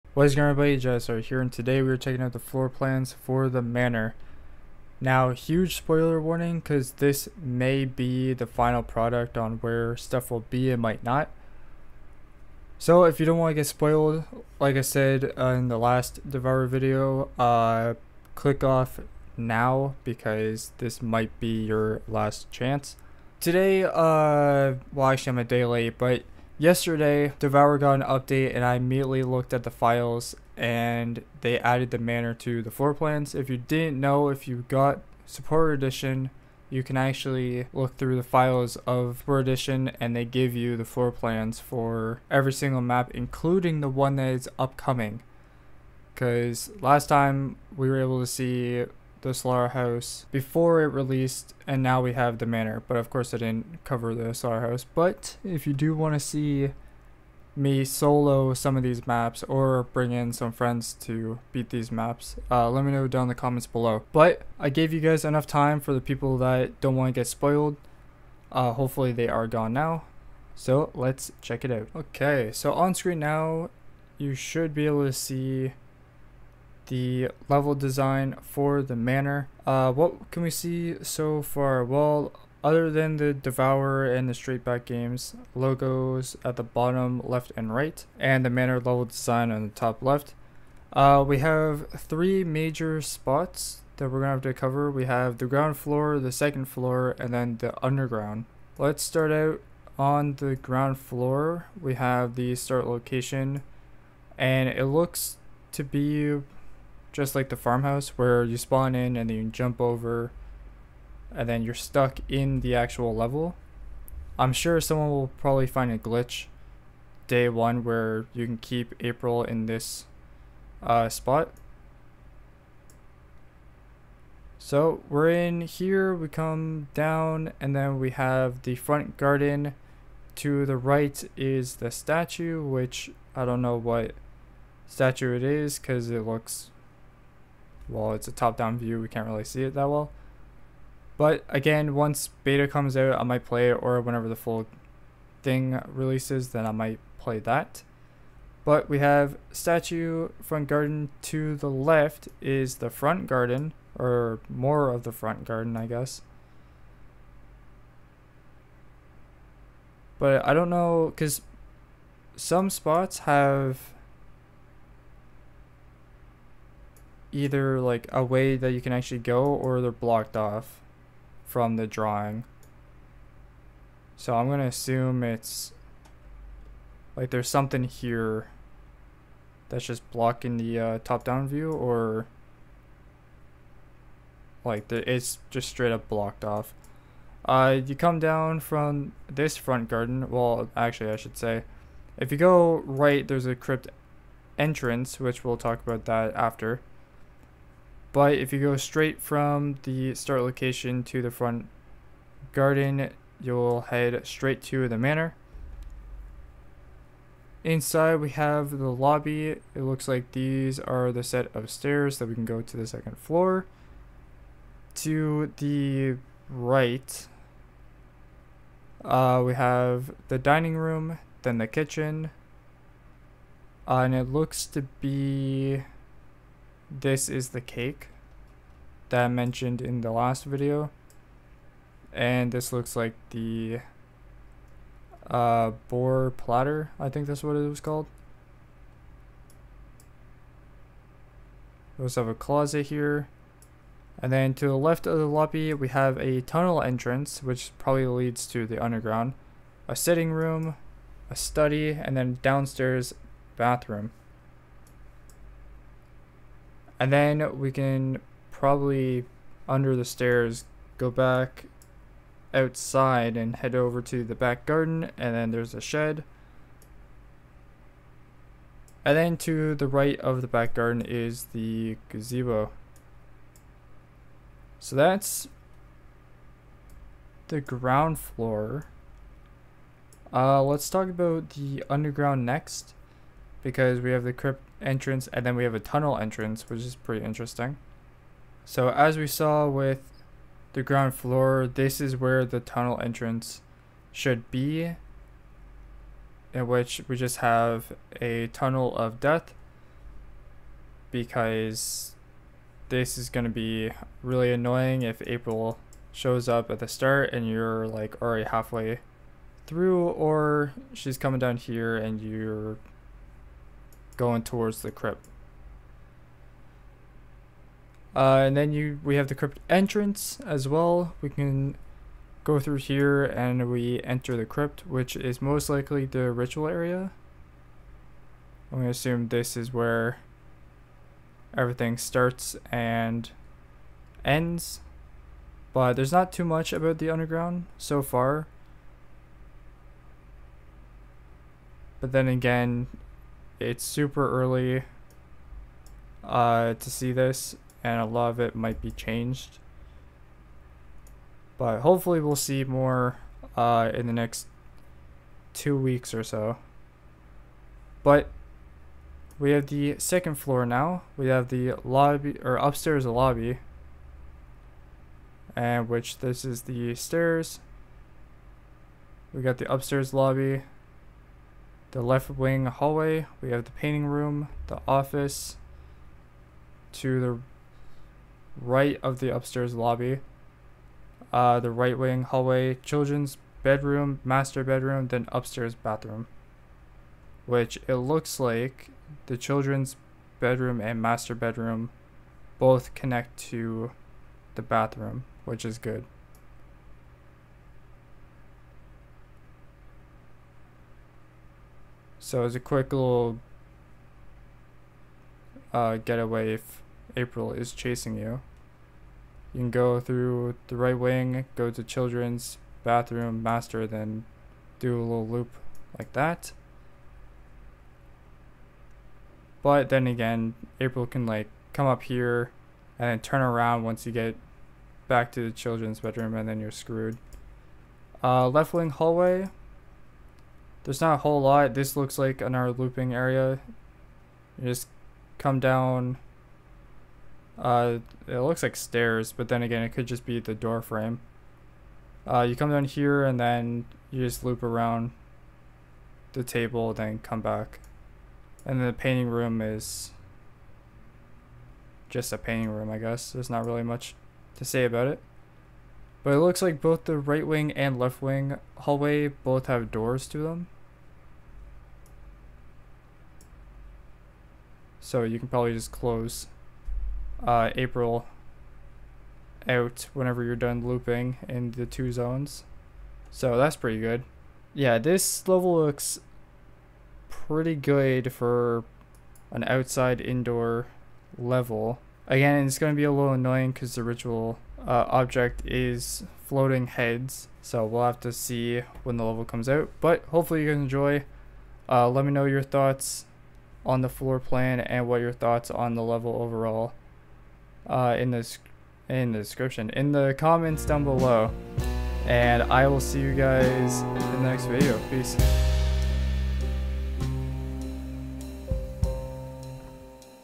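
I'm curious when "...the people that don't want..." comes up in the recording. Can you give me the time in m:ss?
1:05.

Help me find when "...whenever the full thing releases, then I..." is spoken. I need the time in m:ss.
2:24.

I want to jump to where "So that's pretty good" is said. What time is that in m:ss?
7:53.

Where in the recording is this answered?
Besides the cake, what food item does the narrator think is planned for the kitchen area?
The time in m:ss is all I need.
3:55.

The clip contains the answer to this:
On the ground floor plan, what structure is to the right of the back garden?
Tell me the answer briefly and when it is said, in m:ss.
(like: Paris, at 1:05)
The gazebo, at 4:32.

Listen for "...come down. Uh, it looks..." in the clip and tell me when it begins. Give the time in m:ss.
7:15.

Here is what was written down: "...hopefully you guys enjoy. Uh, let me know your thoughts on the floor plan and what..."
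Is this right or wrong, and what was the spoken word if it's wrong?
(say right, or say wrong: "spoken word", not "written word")
right.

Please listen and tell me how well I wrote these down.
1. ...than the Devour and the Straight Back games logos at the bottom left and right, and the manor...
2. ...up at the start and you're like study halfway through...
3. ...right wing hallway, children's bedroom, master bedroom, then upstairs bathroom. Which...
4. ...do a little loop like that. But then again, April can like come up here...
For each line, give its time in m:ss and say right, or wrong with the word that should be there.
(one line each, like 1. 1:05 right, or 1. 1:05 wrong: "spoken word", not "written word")
1. 1:22 right
2. 5:06 wrong: "already", not "study"
3. 6:21 right
4. 6:54 right.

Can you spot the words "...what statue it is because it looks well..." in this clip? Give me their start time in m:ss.
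2:13.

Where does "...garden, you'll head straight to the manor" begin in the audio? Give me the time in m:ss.
3:22.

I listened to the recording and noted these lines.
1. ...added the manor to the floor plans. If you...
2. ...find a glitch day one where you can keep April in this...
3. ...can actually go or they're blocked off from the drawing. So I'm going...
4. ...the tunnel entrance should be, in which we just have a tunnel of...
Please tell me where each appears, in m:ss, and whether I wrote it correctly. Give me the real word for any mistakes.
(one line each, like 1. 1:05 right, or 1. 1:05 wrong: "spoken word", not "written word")
1. 0:31 right
2. 1:55 right
3. 2:48 right
4. 4:52 right.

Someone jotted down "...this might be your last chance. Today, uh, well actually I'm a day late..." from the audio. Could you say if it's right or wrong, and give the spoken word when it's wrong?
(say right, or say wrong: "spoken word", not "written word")
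right.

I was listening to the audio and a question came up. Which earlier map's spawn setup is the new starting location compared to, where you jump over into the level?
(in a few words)
The farmhouse.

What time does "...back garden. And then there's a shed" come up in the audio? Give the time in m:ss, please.
4:24.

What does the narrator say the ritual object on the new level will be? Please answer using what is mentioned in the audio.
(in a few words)
Floating heads.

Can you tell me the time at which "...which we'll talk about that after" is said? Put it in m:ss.
3:15.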